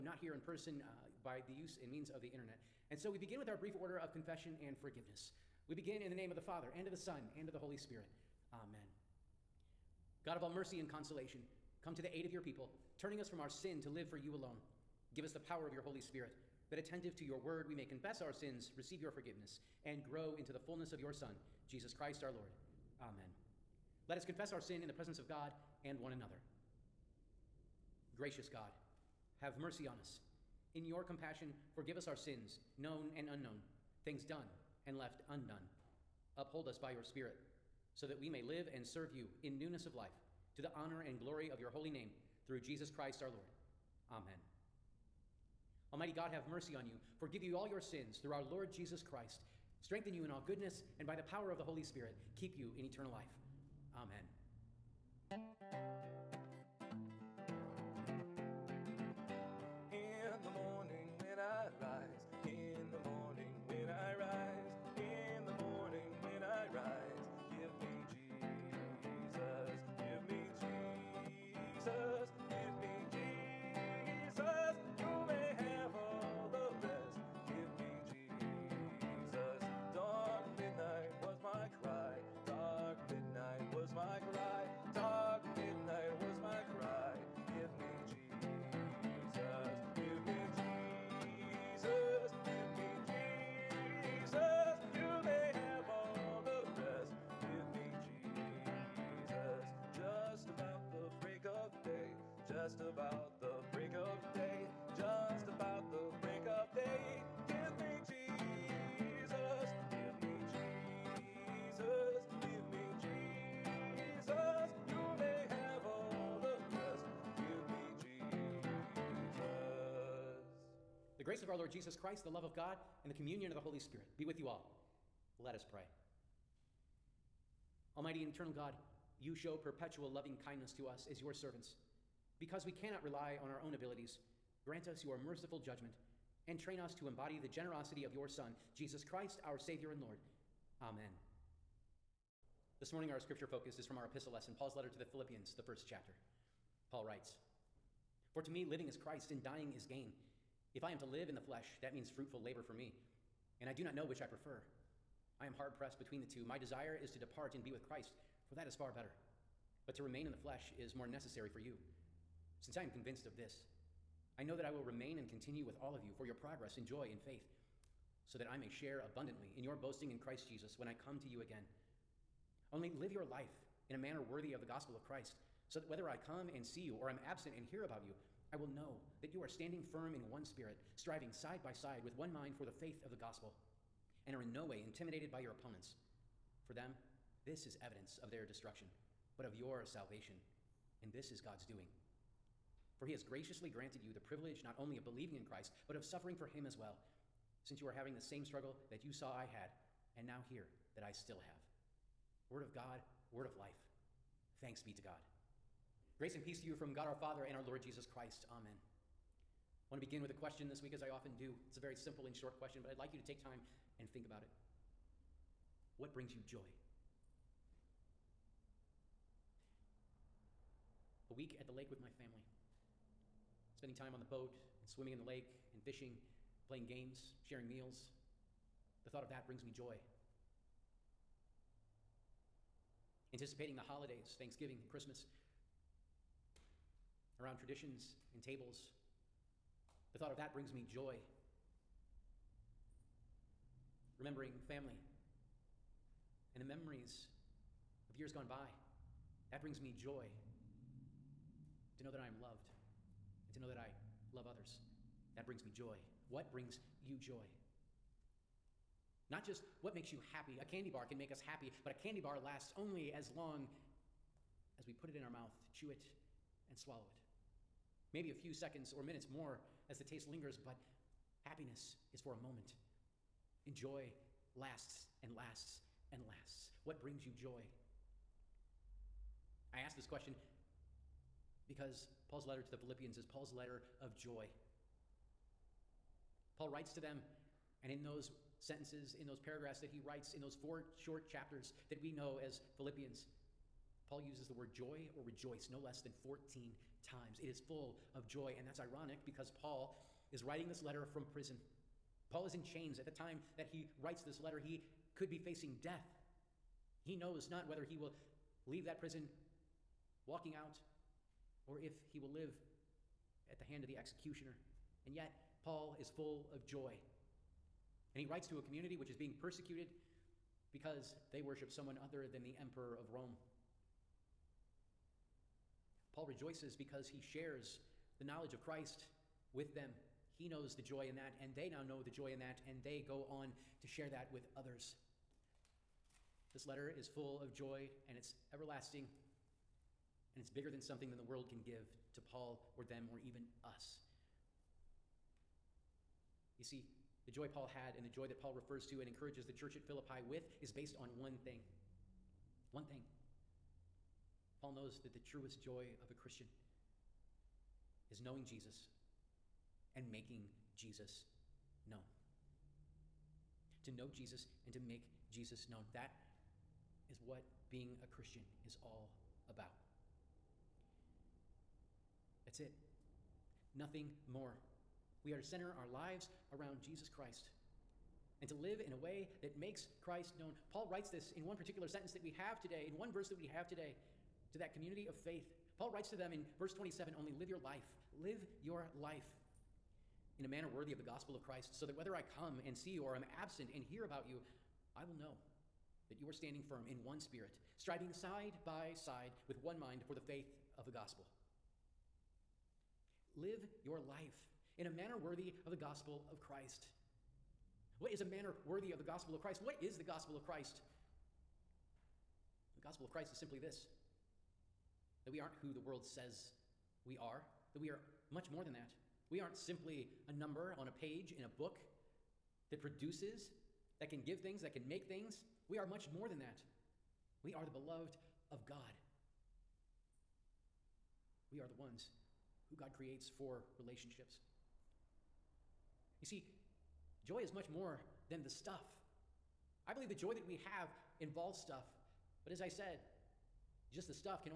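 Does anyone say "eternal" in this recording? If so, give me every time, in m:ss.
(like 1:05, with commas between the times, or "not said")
0:52, 2:08.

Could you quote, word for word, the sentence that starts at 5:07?
He knows not whether he will leave that prison walking out or if he will live at the hand of the executioner.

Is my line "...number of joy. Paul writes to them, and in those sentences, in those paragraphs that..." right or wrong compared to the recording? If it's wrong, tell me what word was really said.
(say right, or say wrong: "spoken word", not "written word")
wrong: "letter", not "number".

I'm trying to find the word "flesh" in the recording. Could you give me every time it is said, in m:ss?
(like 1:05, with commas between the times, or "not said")
2:31, 2:40.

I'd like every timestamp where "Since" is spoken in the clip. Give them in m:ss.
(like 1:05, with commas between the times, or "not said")
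2:42, 3:17.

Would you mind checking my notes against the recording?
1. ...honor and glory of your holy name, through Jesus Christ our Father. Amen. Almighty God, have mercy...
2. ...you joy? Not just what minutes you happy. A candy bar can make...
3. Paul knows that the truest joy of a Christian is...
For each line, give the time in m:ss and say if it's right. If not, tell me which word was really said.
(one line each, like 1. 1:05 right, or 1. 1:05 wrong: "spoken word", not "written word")
1. 0:40 wrong: "Lord", not "Father"
2. 4:17 wrong: "makes", not "minutes"
3. 5:54 right.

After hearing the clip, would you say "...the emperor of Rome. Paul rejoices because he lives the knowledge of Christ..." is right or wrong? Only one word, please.
wrong.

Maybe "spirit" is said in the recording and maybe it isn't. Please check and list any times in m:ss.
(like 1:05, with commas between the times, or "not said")
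0:07, 0:16, 0:37, 0:51, 2:03, 3:00, 6:37.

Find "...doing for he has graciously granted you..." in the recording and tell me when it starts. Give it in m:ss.
3:11.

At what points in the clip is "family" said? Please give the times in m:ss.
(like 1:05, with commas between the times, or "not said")
3:42, 4:04.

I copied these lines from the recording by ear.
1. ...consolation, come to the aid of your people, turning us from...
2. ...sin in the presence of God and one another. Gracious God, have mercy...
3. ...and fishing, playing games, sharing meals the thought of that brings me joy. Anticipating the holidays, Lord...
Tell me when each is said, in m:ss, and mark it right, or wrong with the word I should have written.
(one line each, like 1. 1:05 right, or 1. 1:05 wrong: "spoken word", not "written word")
1. 0:10 right
2. 0:24 right
3. 3:45 wrong: "Thanksgiving", not "Lord".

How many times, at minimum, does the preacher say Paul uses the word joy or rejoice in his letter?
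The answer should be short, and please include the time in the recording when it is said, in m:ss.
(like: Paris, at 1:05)
14, at 4:56.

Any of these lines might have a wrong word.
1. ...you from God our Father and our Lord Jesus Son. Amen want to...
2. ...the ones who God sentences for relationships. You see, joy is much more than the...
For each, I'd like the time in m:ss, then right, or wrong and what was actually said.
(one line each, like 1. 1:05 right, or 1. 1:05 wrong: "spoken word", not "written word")
1. 3:26 wrong: "Christ", not "Son"
2. 7:11 wrong: "creates", not "sentences".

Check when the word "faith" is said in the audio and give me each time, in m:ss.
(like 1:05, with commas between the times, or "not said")
2:47, 3:02, 6:25, 6:40.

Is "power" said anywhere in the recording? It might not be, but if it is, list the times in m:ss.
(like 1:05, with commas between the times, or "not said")
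0:15, 0:51.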